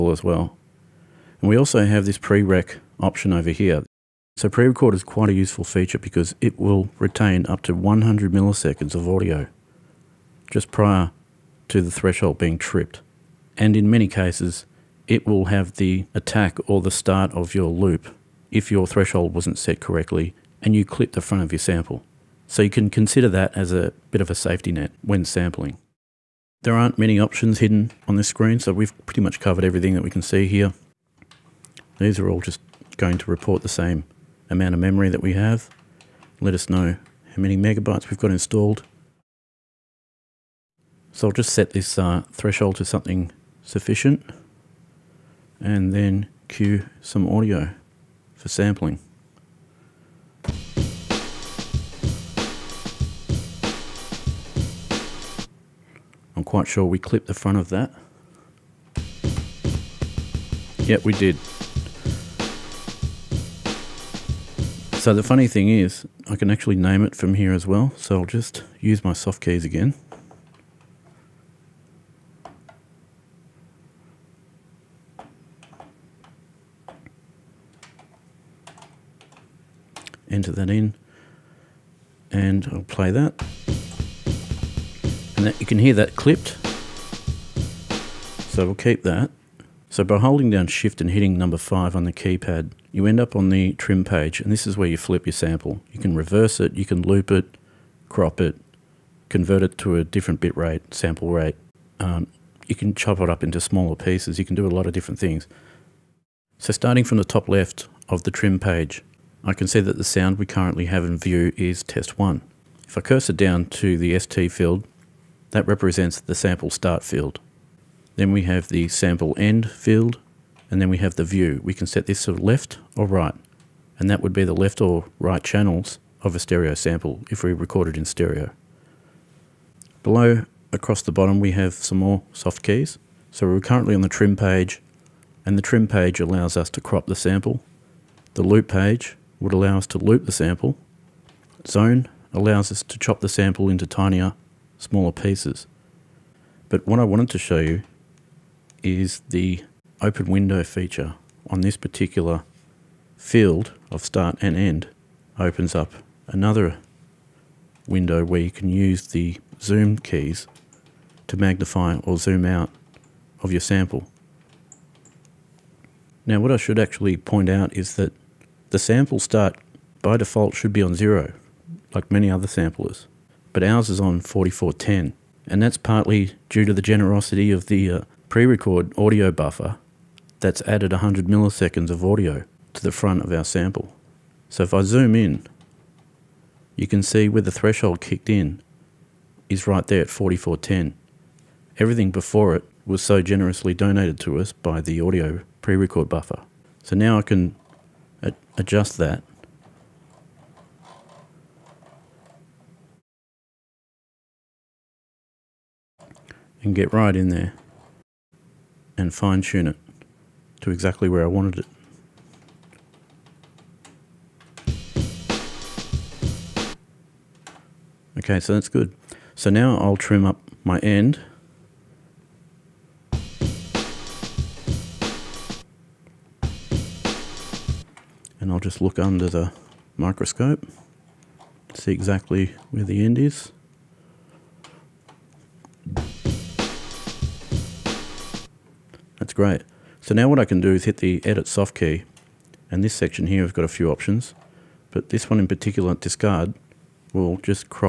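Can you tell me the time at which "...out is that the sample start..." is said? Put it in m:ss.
2:47.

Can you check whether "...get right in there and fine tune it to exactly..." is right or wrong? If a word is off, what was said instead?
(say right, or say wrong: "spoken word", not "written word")
right.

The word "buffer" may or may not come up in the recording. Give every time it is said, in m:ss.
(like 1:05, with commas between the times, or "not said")
2:59, 3:16.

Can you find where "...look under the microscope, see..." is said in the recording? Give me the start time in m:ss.
3:48.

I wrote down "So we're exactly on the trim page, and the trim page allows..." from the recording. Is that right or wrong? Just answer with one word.
wrong.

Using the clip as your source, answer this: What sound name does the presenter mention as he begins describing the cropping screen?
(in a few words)
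test 1.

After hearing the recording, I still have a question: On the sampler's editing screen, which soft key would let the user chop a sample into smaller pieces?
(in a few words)
Zone.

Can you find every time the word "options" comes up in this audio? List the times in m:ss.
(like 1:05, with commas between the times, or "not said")
0:02, 0:27, 4:03.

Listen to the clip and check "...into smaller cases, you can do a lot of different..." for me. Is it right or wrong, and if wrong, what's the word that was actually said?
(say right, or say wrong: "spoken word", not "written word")
wrong: "pieces", not "cases".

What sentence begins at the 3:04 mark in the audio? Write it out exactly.
So if I zoom in, you can see where the threshold kicked in is right there at 4410.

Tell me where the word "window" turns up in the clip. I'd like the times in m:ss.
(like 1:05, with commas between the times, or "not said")
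2:30, 2:37.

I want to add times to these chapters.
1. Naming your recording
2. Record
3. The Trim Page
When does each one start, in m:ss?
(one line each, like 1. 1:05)
1. 1:06
2. 0:51
3. 1:31.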